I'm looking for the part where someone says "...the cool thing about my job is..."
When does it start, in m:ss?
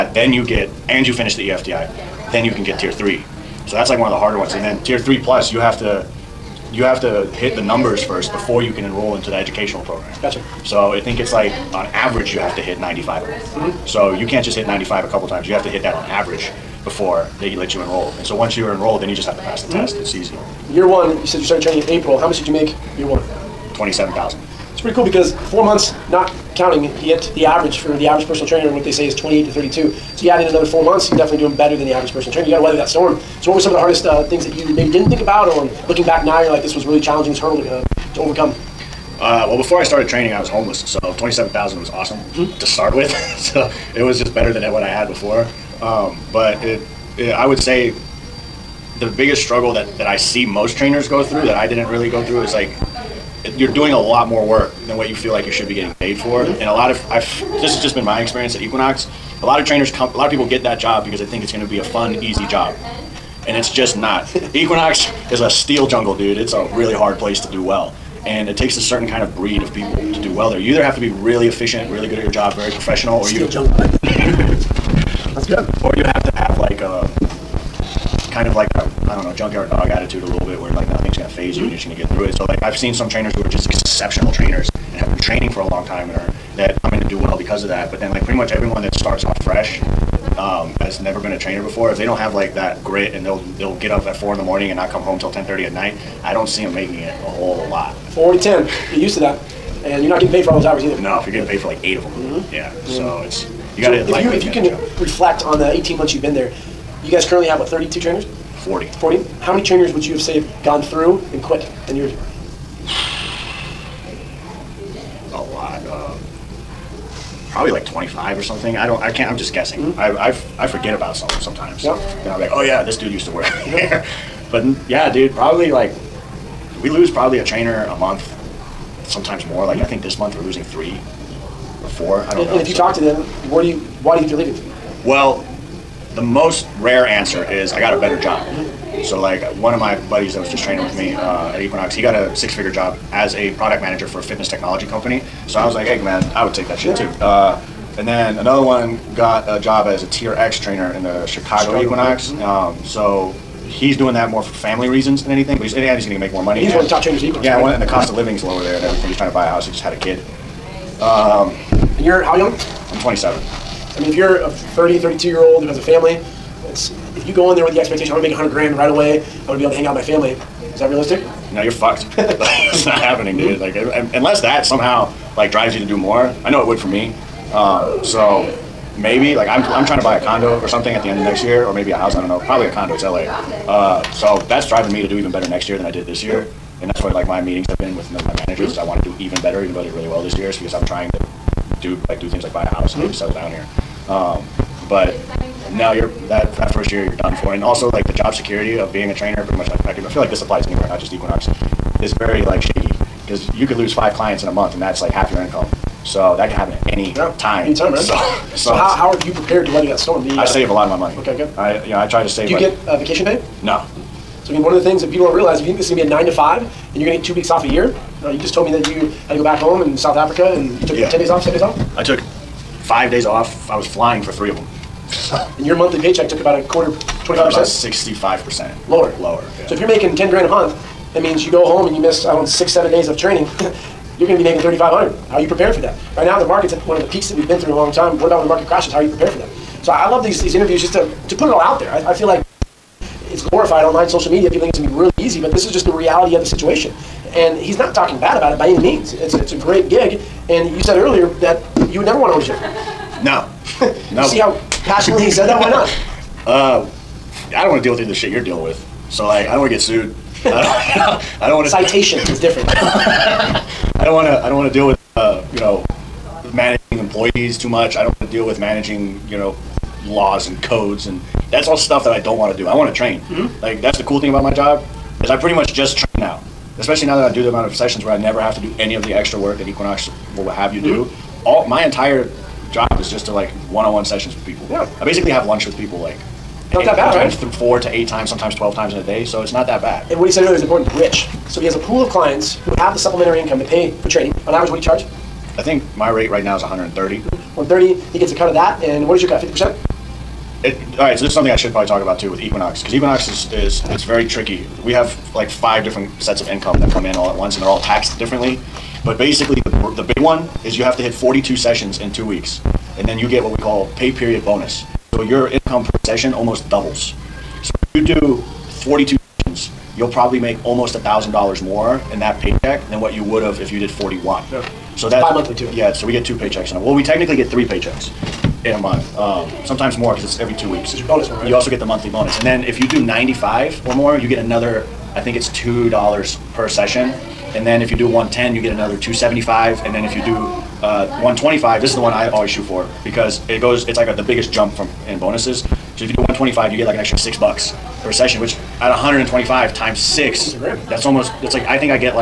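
4:33.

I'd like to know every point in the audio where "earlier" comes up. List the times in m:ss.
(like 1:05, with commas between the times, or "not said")
4:10, 4:50.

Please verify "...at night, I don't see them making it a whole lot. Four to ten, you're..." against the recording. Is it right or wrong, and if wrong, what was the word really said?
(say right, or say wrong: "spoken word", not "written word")
right.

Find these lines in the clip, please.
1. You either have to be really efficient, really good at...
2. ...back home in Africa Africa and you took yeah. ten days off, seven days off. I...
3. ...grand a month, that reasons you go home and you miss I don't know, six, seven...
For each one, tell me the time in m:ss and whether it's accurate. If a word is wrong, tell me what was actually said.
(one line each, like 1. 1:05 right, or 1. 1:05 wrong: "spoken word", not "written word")
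1. 1:10 right
2. 3:39 wrong: "South", not "Africa"
3. 3:50 wrong: "means", not "reasons".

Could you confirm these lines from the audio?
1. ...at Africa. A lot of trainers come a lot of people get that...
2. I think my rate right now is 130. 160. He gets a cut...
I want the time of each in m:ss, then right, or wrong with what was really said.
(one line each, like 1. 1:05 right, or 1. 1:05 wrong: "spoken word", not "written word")
1. 0:58 wrong: "Equinox", not "Africa"
2. 4:55 wrong: "130", not "160".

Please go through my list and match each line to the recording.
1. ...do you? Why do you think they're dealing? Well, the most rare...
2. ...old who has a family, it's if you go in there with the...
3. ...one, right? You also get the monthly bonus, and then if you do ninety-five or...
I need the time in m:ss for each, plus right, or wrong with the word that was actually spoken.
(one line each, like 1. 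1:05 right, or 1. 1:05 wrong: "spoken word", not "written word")
1. 2:13 wrong: "leaving", not "dealing"
2. 2:45 right
3. 5:31 right.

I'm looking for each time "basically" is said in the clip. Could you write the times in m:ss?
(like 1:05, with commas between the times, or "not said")
4:45, 5:09.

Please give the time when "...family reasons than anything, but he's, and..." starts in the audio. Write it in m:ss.
2:34.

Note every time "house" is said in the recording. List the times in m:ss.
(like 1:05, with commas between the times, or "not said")
2:39, 3:01, 3:12.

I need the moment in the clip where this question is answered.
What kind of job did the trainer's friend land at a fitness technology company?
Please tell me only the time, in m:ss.
2:23.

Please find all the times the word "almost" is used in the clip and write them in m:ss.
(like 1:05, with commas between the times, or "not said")
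5:16, 5:20, 5:51.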